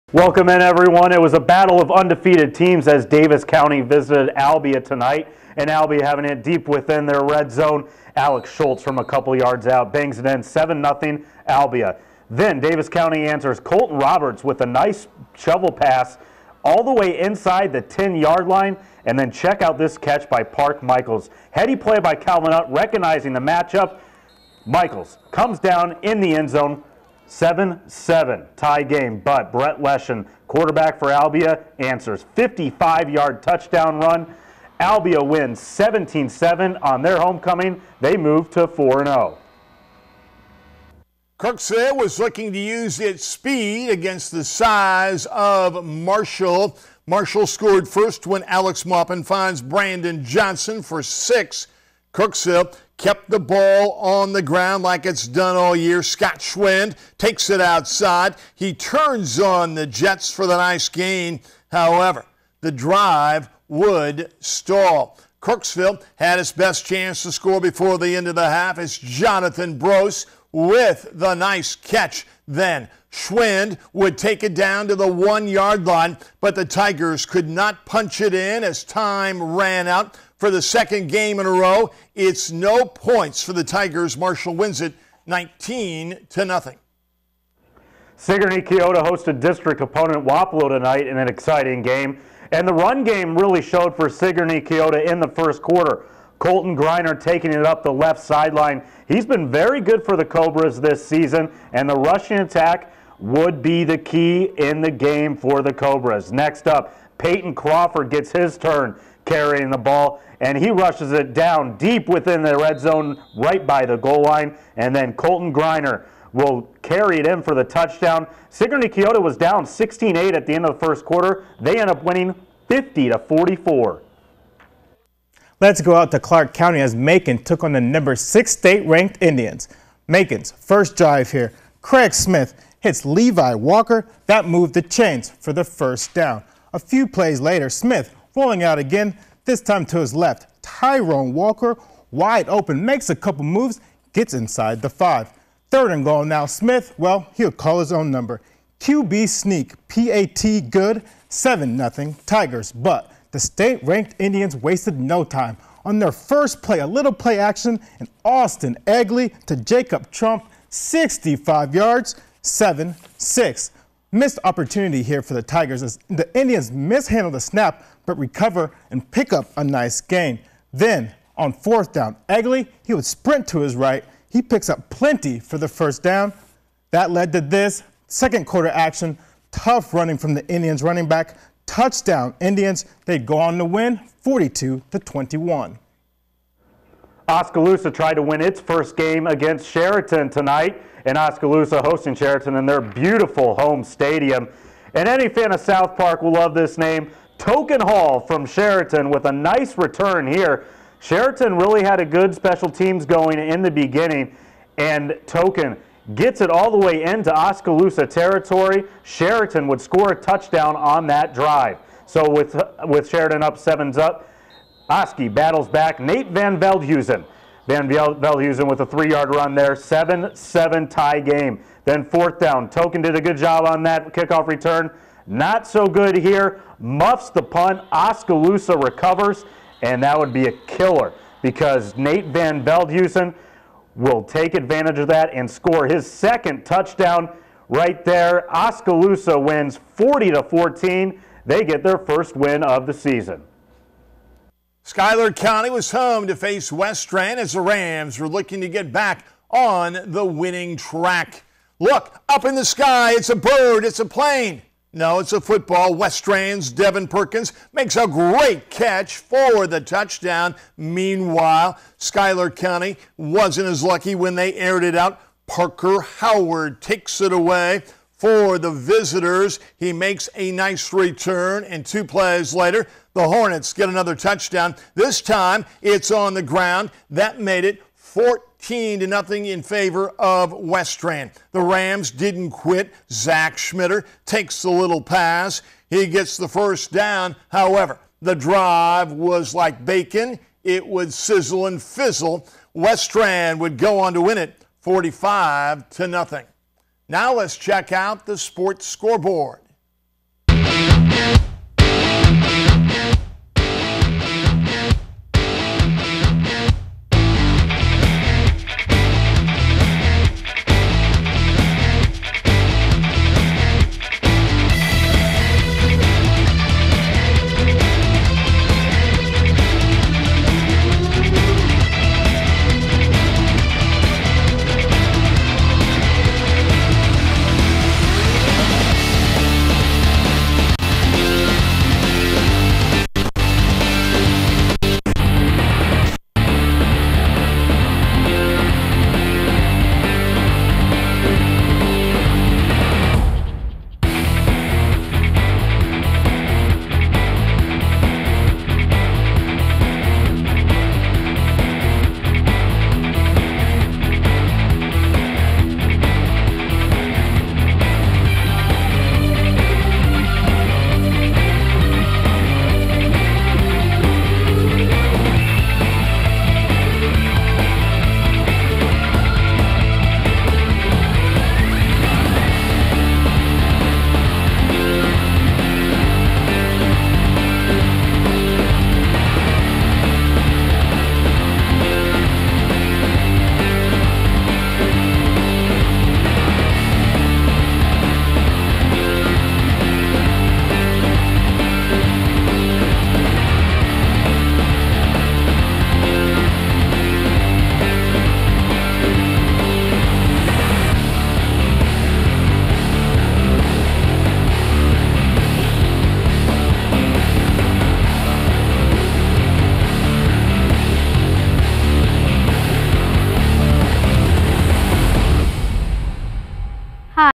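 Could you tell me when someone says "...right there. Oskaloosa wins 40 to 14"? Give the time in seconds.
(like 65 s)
237 s.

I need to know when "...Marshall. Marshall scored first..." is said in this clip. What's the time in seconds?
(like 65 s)
45 s.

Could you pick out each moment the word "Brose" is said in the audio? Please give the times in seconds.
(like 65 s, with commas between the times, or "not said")
69 s.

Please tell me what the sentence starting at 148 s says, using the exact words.
QB sneak, PAT good, 7 0 Tigers.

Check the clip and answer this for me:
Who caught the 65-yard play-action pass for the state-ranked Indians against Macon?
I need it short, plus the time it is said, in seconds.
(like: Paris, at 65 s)
Jacob Trump, at 159 s.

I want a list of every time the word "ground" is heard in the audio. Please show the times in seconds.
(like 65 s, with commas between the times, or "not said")
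54 s, 276 s.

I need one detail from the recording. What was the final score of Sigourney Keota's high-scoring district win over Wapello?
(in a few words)
50-44.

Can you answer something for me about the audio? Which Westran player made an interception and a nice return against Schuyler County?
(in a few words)
Parker Howard.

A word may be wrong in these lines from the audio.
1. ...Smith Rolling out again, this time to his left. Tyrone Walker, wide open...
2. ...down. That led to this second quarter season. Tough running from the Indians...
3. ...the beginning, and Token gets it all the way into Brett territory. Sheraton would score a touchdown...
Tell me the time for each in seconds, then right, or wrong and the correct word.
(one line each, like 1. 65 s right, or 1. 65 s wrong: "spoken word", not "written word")
1. 137 s right
2. 176 s wrong: "action", not "season"
3. 203 s wrong: "Oskaloosa", not "Brett".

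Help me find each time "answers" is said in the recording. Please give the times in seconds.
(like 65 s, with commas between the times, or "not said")
13 s, 31 s.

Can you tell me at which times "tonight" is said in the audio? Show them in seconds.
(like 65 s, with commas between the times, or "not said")
4 s, 90 s, 190 s.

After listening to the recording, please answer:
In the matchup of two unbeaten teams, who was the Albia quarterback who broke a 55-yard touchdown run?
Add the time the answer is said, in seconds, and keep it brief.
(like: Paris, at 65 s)
Brett Leshen, at 29 s.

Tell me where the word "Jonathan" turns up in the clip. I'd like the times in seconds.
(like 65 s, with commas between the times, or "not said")
68 s.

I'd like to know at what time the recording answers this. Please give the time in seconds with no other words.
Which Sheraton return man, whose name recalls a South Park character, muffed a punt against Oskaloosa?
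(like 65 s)
197 s.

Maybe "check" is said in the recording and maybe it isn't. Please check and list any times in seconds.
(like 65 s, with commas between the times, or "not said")
19 s, 297 s.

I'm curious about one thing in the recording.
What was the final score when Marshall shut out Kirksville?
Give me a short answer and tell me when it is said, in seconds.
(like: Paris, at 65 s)
19-0, at 85 s.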